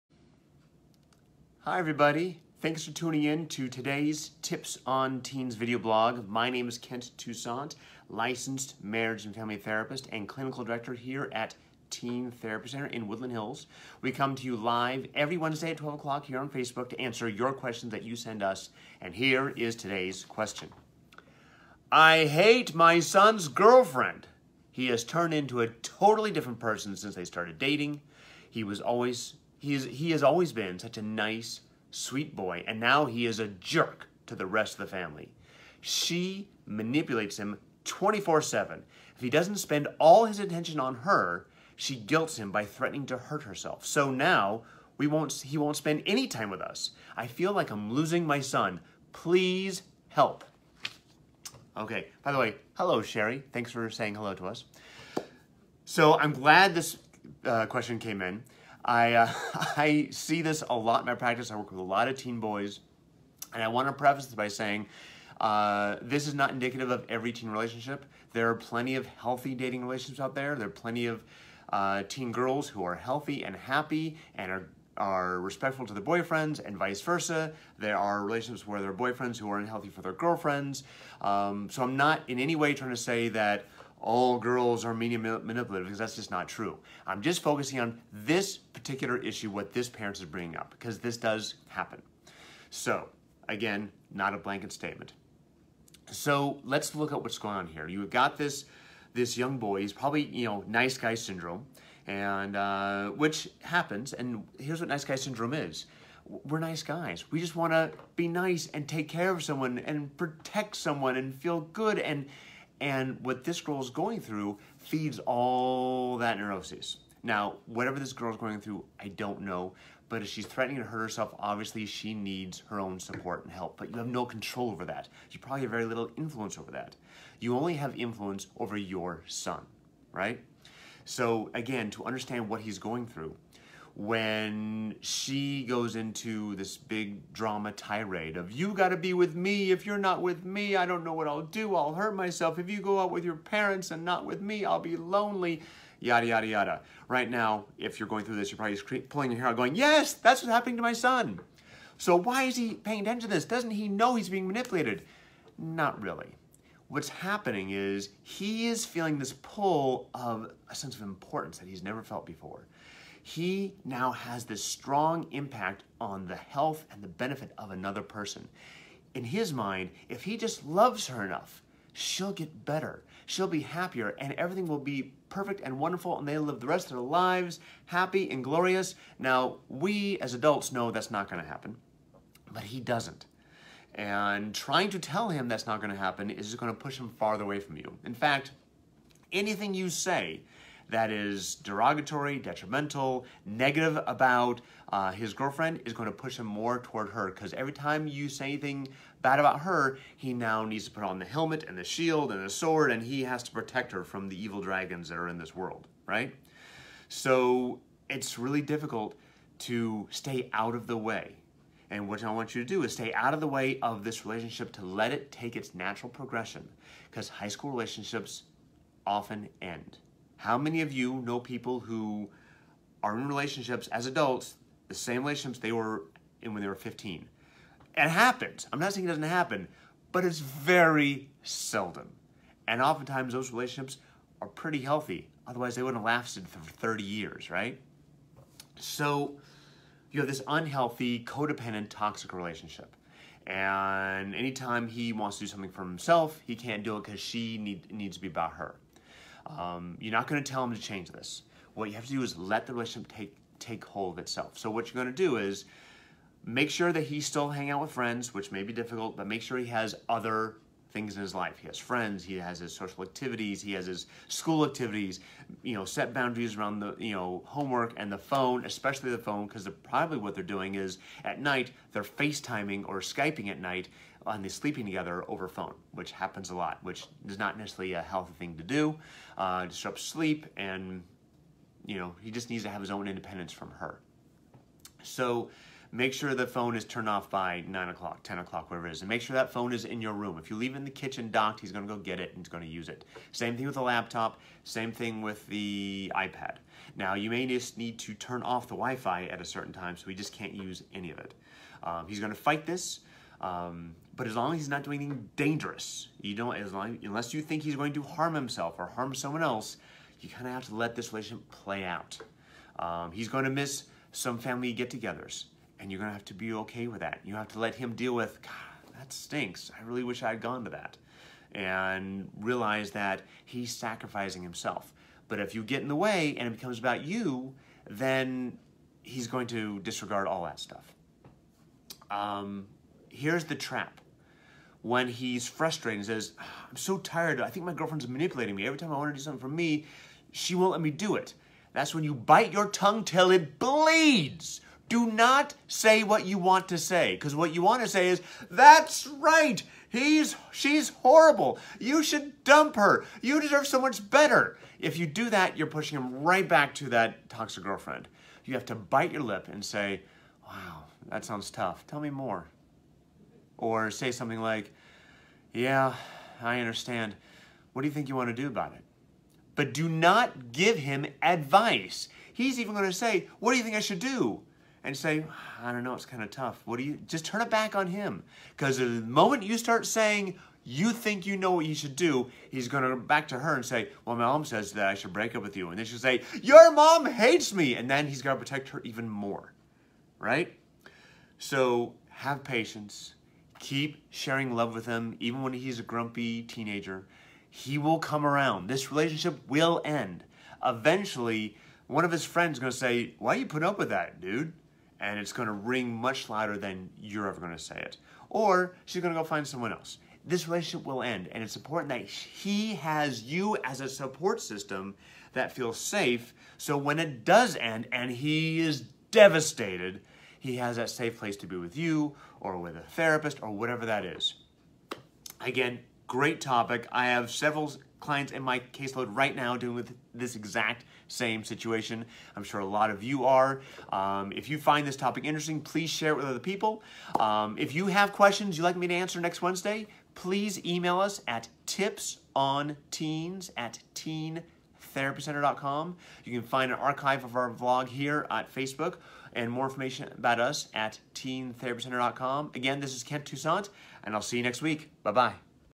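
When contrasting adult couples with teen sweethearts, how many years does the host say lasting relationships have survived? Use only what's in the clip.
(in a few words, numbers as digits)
30.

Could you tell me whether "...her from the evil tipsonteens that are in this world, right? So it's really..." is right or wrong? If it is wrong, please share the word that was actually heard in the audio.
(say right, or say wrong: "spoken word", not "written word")
wrong: "dragons", not "tipsonteens".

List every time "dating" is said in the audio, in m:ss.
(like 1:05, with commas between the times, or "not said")
0:27, 1:09.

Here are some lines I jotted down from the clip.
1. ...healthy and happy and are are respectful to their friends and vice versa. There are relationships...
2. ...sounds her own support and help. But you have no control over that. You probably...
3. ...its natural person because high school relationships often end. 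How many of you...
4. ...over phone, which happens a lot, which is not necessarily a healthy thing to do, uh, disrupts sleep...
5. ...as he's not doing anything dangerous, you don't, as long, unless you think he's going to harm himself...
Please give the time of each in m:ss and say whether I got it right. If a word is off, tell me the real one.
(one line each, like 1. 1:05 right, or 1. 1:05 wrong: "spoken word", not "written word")
1. 1:12 wrong: "boyfriends", not "friends"
2. 2:02 wrong: "needs", not "sounds"
3. 3:35 wrong: "progression", not "person"
4. 4:35 right
5. 5:04 right.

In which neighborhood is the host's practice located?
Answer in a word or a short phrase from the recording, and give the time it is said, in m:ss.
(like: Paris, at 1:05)
Woodland Hills, at 0:13.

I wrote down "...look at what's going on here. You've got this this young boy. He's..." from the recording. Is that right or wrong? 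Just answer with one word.
right.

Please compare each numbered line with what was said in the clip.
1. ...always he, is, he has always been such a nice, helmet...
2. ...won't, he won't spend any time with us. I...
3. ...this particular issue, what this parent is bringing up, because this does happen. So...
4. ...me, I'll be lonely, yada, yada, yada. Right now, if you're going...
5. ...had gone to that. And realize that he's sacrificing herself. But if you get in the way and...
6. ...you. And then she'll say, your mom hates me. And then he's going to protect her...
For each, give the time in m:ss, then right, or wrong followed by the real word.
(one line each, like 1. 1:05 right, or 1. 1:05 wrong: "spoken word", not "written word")
1. 0:28 wrong: "sweet", not "helmet"
2. 0:45 right
3. 1:28 right
4. 2:24 right
5. 5:20 wrong: "himself", not "herself"
6. 6:25 right.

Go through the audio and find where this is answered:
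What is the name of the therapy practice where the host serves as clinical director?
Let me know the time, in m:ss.
0:11.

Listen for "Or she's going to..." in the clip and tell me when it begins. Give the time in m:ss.
6:48.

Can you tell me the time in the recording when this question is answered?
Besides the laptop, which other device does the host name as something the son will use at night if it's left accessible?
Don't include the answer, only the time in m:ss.
4:56.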